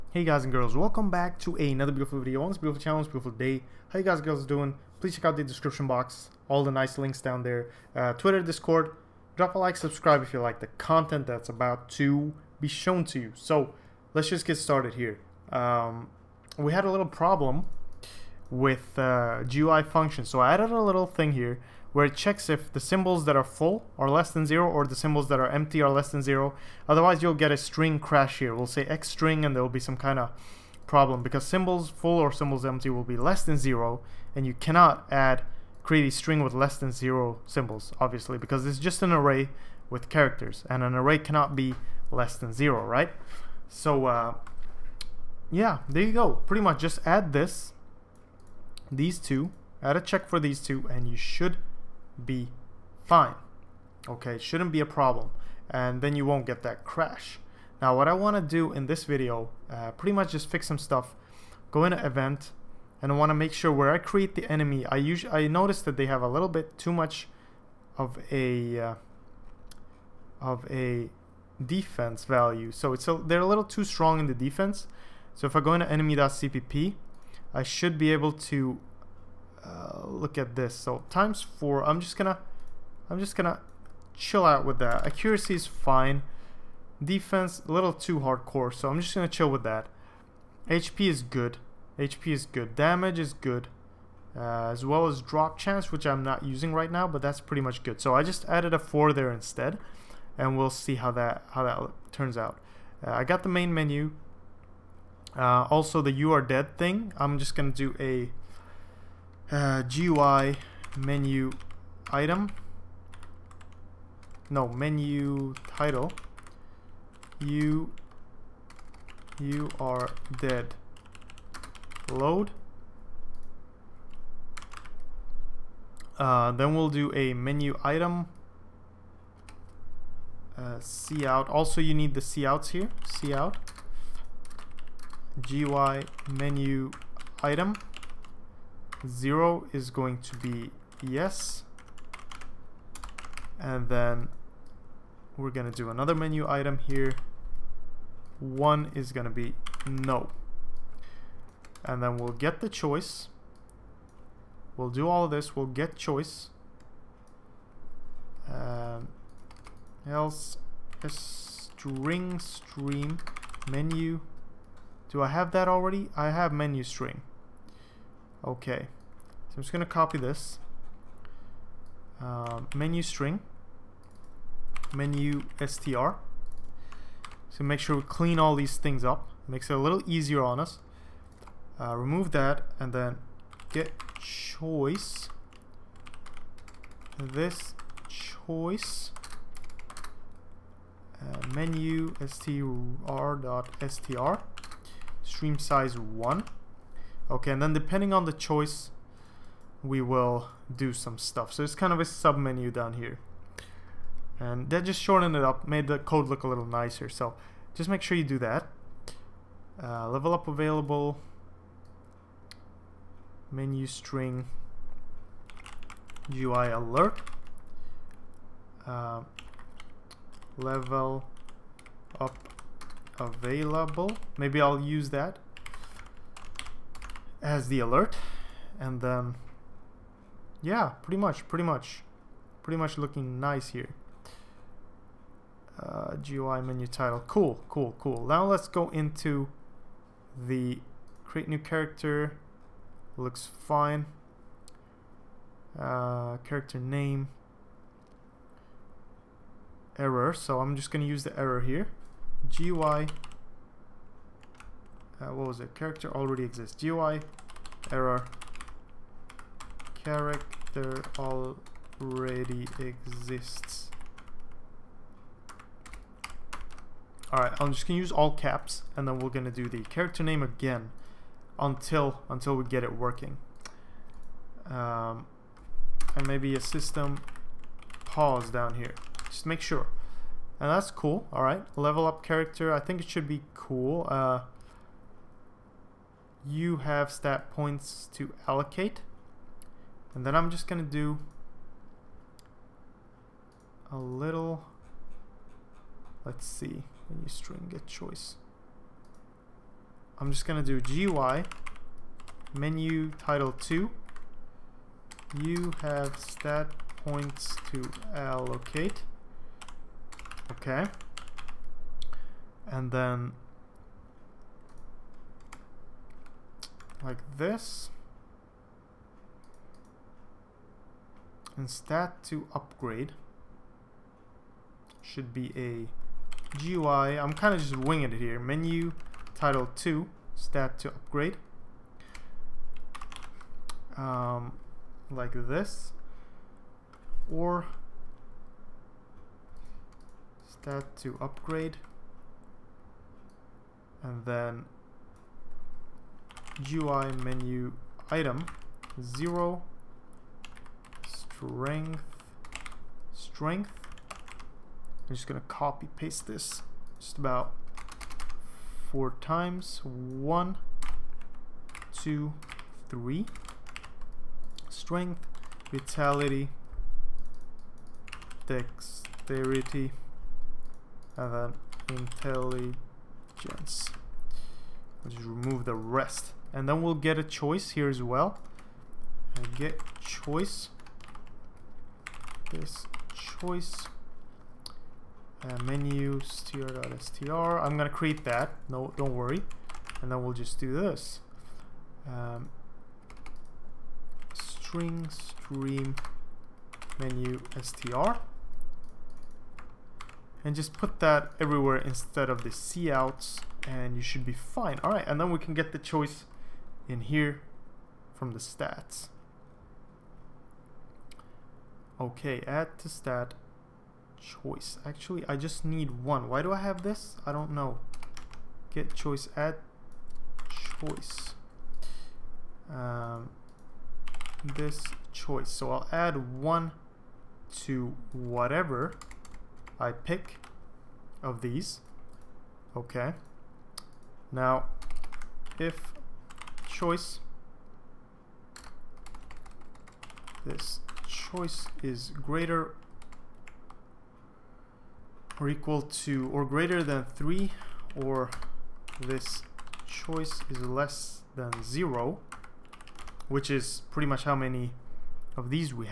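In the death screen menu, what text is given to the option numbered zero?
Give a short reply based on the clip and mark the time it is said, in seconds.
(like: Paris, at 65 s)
yes, at 139 s.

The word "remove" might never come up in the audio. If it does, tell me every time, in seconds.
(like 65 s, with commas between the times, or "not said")
181 s, 375 s.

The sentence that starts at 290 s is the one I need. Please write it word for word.
And then I'm just going to do a little, let's see, when you string get choice.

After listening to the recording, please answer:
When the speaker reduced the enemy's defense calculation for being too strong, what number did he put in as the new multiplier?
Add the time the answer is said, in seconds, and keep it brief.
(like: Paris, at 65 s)
4, at 98 s.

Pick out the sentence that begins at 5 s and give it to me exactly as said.
Please check out the description box, all the nice links down there.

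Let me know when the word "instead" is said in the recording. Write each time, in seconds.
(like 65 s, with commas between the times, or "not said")
99 s, 401 s.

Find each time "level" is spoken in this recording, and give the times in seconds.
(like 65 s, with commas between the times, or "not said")
210 s, 220 s, 281 s.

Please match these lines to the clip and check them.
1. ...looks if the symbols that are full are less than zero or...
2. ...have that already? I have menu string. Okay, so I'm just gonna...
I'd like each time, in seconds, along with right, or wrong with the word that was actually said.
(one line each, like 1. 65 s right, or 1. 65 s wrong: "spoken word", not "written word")
1. 22 s wrong: "checks", not "looks"
2. 165 s right.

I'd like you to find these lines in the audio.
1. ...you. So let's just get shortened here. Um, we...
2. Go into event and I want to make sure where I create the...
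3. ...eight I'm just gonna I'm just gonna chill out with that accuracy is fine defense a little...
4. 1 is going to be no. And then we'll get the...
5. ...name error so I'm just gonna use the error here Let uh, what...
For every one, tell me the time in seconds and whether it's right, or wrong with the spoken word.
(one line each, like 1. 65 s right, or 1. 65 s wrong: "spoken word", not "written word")
1. 13 s wrong: "started", not "shortened"
2. 61 s right
3. 81 s wrong: "four", not "eight"
4. 148 s right
5. 246 s wrong: "GUI", not "Let".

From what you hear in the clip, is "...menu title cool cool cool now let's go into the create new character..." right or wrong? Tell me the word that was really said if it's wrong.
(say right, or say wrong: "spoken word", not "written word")
right.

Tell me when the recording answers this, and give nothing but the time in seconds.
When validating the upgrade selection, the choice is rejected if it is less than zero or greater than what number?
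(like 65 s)
446 s.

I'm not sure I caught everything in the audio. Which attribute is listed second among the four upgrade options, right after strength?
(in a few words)
vitality.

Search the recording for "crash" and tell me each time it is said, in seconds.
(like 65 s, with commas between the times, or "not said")
27 s, 56 s.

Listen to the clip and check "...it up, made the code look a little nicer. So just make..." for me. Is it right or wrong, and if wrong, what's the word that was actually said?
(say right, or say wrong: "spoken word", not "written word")
right.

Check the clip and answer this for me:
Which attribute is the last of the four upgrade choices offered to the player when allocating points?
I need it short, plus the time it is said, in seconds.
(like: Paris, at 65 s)
intelligence, at 371 s.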